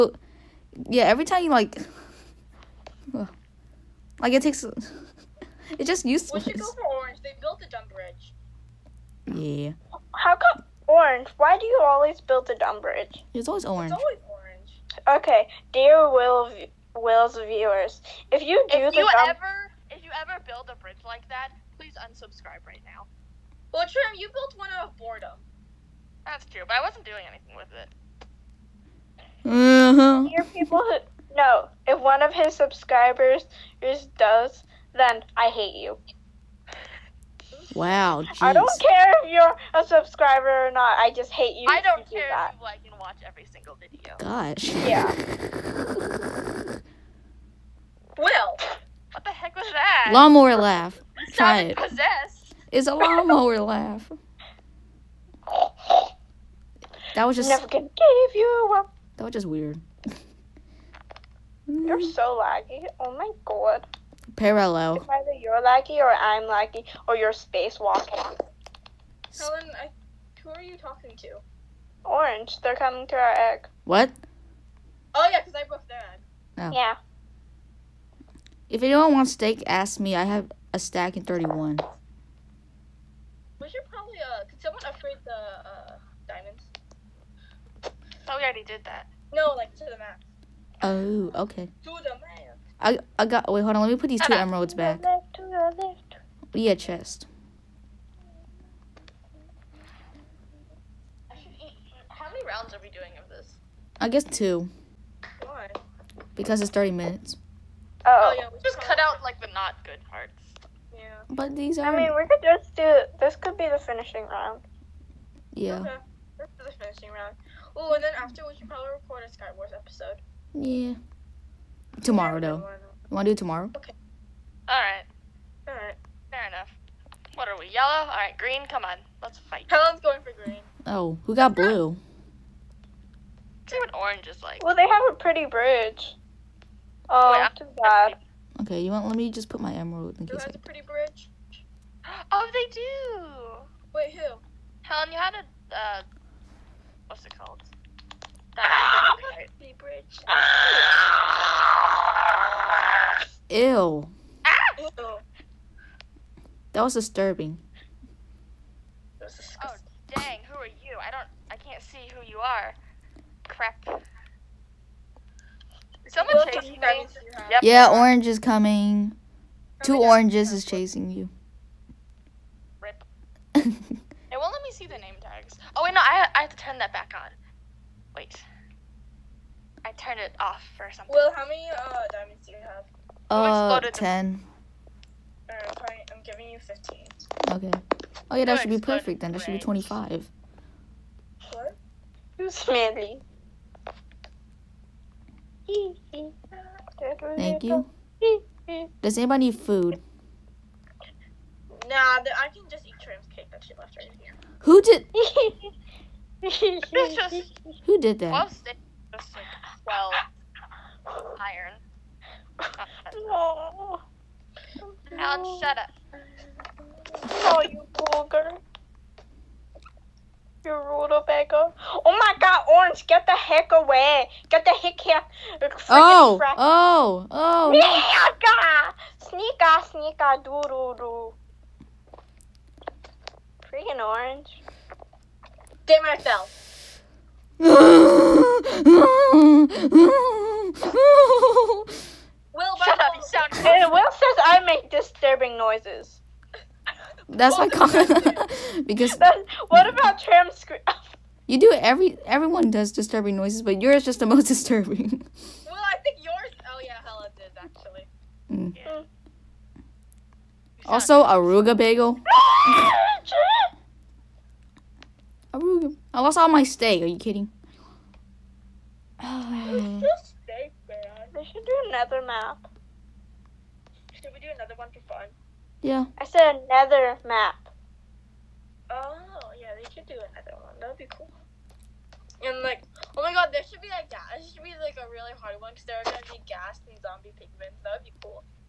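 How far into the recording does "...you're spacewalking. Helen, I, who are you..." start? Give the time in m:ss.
1:07.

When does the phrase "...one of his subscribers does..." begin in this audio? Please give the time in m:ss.
0:31.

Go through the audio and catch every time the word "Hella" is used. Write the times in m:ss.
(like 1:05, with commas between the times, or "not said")
4:17.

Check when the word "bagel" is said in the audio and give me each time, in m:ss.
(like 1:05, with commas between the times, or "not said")
4:21.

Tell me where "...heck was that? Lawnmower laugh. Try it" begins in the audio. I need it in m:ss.
0:49.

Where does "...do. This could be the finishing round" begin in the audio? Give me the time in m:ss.
1:52.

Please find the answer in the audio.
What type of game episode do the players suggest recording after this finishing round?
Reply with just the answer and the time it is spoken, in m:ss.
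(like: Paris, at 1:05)
Skywars, at 1:59.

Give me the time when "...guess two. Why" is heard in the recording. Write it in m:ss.
1:44.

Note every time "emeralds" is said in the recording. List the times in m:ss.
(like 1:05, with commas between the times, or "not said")
1:34, 2:19.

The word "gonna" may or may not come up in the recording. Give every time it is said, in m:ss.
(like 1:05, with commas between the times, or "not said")
0:57.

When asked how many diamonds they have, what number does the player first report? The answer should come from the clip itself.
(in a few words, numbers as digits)
10.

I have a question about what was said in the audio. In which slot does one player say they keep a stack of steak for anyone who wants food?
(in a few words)
31.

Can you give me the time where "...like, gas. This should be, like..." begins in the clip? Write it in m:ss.
4:43.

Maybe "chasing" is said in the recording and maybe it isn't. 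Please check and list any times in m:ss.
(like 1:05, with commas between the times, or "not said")
2:46, 2:50.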